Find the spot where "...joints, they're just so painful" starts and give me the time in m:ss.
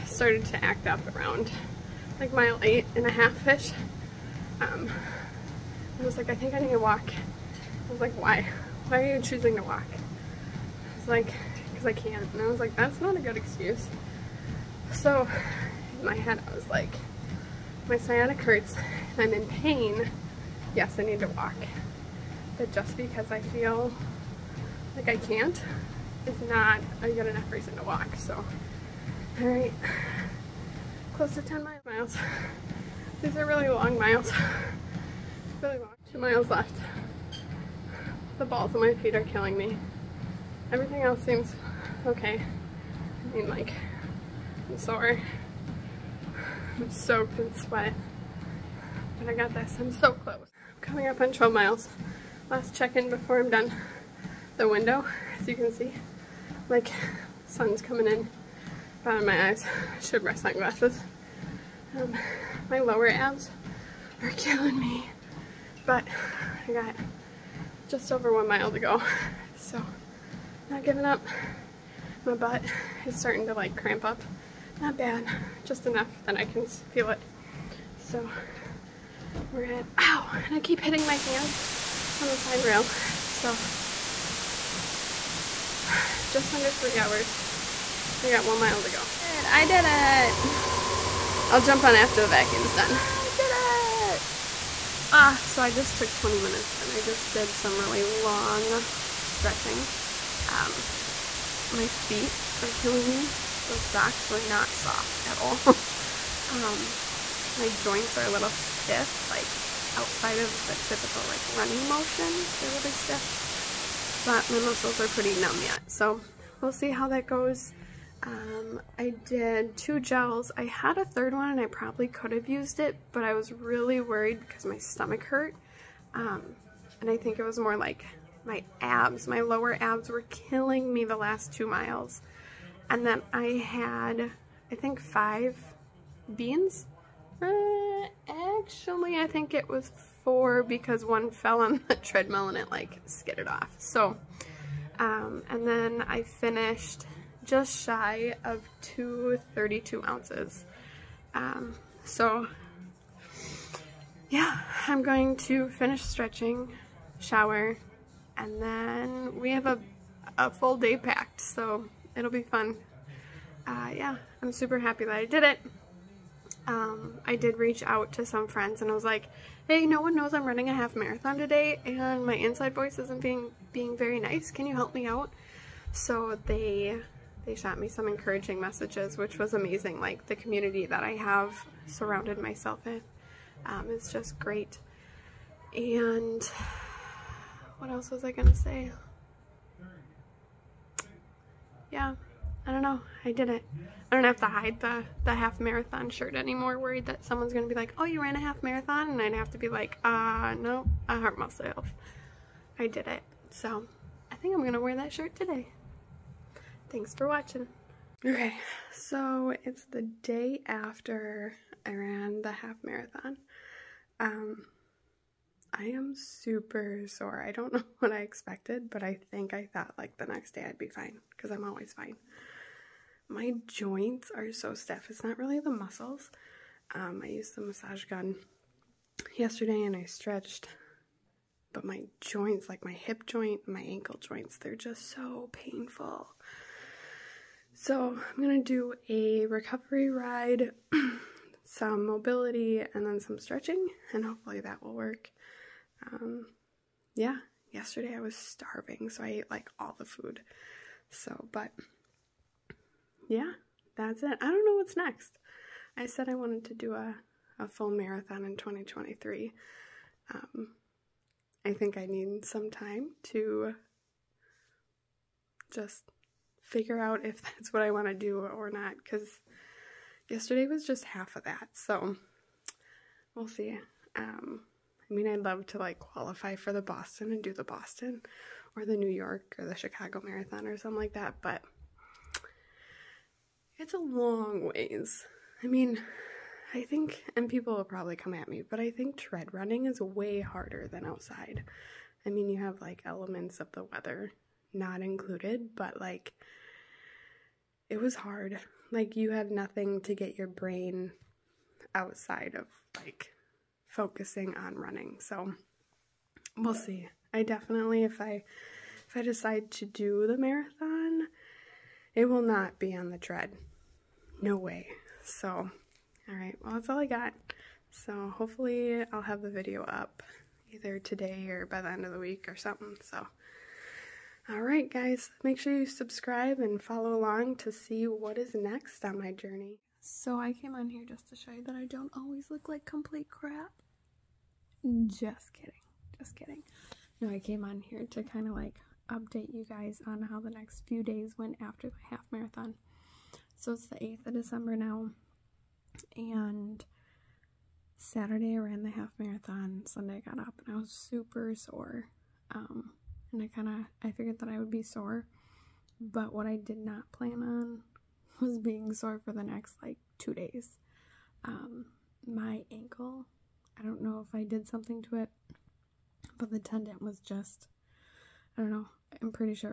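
3:54.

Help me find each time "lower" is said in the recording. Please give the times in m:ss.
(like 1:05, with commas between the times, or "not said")
1:02, 2:09.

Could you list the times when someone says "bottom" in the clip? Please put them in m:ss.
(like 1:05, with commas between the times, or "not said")
0:59.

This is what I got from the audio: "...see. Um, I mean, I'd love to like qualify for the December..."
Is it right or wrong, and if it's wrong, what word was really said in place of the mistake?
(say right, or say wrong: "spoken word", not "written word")
wrong: "Boston", not "December".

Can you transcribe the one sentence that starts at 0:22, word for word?
But just because I feel like I can't is not a good enough reason to walk.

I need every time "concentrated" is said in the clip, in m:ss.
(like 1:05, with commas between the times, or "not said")
not said.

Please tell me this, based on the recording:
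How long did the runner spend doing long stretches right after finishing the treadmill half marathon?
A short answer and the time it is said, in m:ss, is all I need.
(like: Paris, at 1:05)
20 minutes, at 1:36.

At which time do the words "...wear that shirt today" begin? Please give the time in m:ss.
3:24.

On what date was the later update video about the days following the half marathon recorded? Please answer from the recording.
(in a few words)
8th of December.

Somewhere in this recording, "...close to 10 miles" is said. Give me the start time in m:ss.
0:31.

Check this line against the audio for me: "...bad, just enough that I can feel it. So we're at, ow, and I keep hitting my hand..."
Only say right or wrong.
right.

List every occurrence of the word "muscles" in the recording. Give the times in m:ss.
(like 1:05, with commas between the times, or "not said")
1:54, 3:45.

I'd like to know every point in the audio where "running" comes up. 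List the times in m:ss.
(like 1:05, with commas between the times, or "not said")
1:51, 2:50, 4:49, 5:04.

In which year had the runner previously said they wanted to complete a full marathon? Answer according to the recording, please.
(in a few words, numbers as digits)
2023.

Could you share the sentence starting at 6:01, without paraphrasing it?
Um, my ankle, I don't know if I did something to it, but the tendon was just I don't know.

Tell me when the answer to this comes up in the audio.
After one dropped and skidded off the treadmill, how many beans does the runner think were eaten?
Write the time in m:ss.
2:20.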